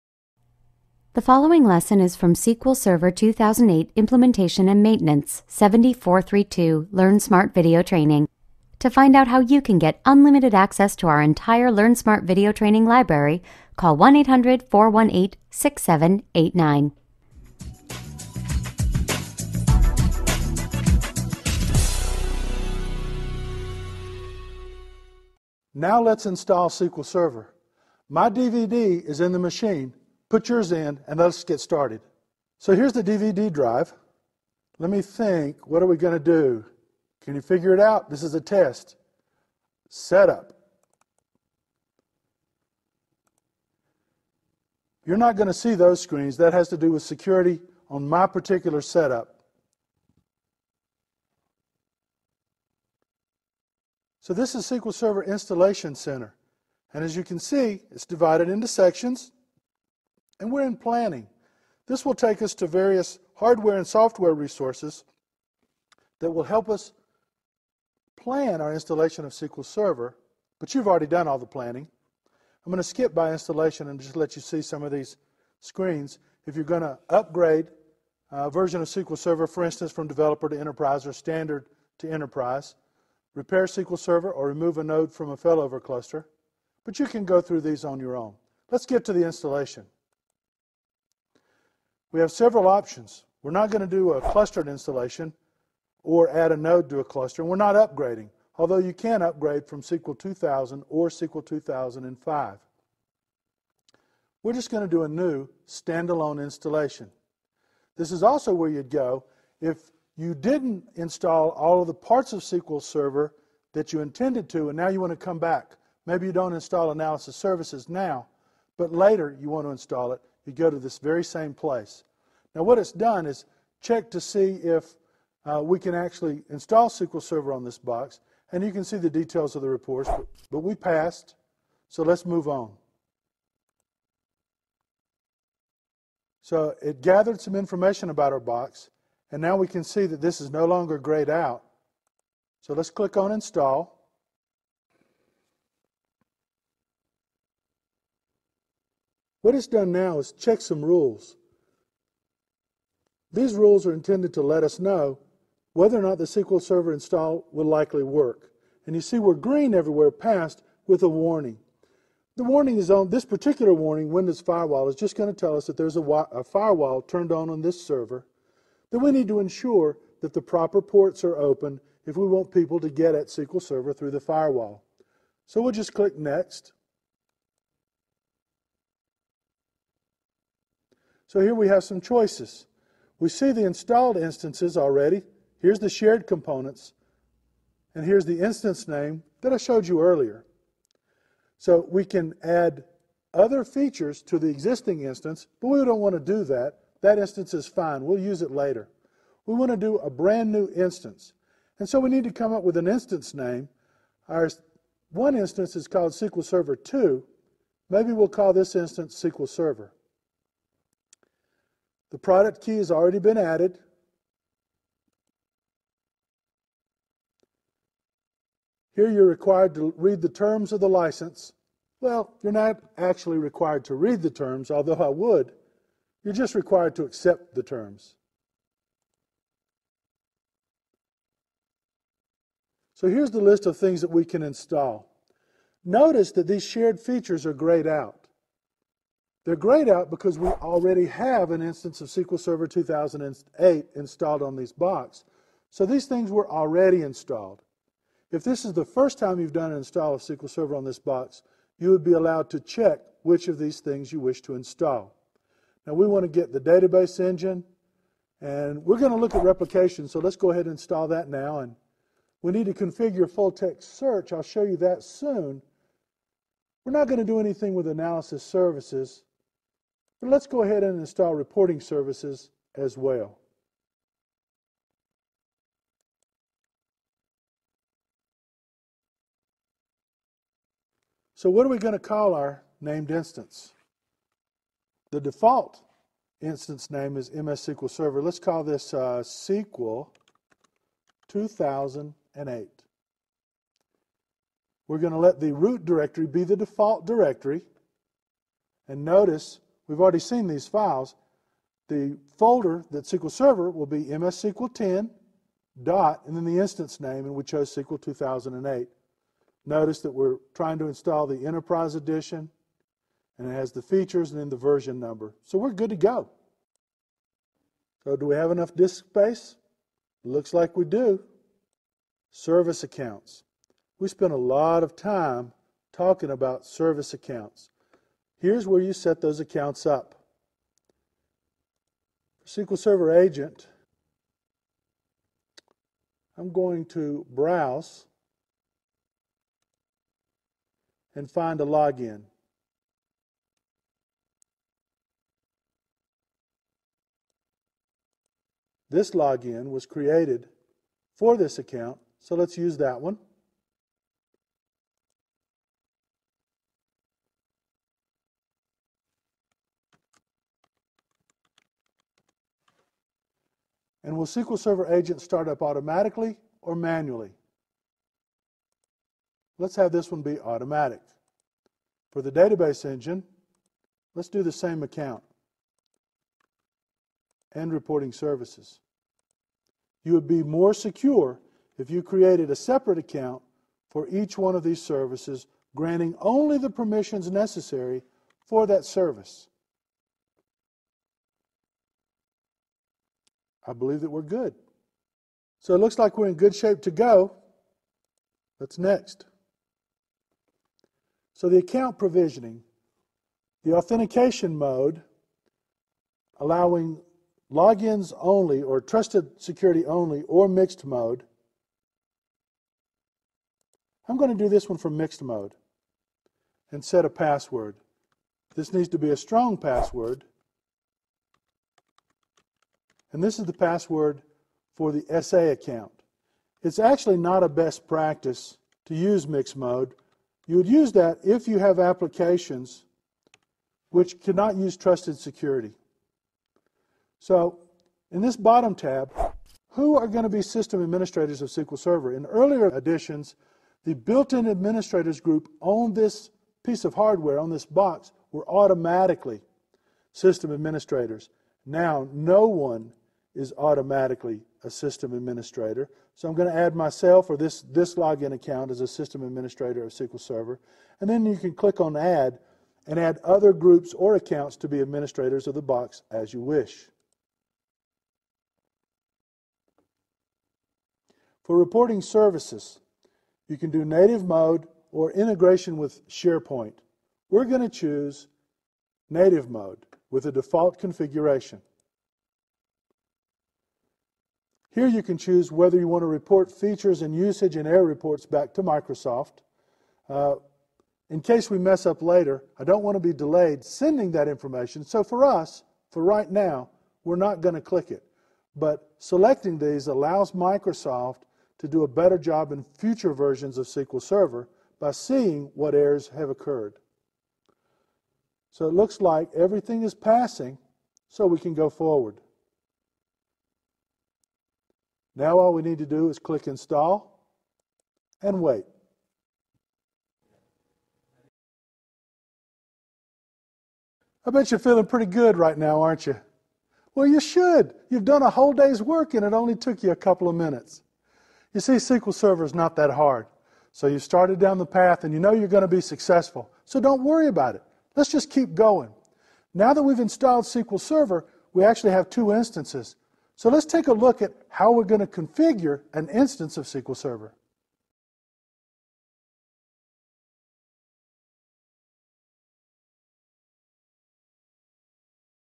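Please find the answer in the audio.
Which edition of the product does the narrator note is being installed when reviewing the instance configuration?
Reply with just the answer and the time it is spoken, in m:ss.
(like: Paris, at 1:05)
Enterprise Edition, at 5:11.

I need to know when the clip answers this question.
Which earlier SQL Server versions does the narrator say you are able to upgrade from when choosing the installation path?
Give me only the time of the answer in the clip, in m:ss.
1:39.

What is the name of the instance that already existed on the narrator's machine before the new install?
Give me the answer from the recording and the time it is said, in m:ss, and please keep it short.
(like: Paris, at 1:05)
SQL Server 2, at 3:26.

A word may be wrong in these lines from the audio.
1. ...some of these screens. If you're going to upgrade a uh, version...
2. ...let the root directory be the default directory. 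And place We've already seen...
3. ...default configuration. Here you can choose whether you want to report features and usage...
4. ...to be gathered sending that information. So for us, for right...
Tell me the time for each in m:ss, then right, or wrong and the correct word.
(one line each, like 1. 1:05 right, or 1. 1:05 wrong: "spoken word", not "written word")
1. 1:14 right
2. 4:55 wrong: "notice", not "place"
3. 8:00 right
4. 8:12 wrong: "delayed", not "gathered".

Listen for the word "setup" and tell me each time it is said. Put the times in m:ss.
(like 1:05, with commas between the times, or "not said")
0:39, 0:48.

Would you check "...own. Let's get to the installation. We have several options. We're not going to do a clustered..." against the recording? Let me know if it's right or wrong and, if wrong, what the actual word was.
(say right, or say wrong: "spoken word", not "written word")
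right.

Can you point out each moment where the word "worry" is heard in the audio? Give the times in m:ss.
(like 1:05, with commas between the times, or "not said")
8:57.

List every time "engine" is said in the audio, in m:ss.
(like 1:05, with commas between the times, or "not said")
4:17, 6:12.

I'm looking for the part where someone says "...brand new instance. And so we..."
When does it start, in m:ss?
3:20.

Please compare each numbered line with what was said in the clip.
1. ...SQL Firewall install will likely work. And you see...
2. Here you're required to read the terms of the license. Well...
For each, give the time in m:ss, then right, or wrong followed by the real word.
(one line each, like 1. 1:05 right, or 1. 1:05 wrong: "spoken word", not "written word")
1. 2:36 wrong: "Server", not "Firewall"
2. 3:38 right.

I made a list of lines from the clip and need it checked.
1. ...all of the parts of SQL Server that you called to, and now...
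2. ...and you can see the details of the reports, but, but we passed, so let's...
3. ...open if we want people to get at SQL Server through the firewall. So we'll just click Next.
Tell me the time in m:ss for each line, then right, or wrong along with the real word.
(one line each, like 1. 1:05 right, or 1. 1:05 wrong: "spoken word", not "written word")
1. 1:51 wrong: "intended", not "called"
2. 2:08 right
3. 2:51 right.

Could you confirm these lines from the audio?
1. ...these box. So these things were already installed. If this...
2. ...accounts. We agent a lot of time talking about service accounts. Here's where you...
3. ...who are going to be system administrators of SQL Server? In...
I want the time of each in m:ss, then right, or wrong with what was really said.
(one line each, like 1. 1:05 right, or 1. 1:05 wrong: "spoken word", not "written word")
1. 4:04 right
2. 5:22 wrong: "spent", not "agent"
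3. 7:19 right.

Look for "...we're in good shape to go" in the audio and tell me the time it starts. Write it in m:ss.
6:36.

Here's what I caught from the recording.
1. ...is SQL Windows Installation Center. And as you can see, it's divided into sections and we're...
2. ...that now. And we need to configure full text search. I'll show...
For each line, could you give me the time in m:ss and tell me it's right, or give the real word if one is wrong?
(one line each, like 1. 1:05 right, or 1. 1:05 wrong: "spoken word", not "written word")
1. 0:54 wrong: "Server", not "Windows"
2. 4:21 right.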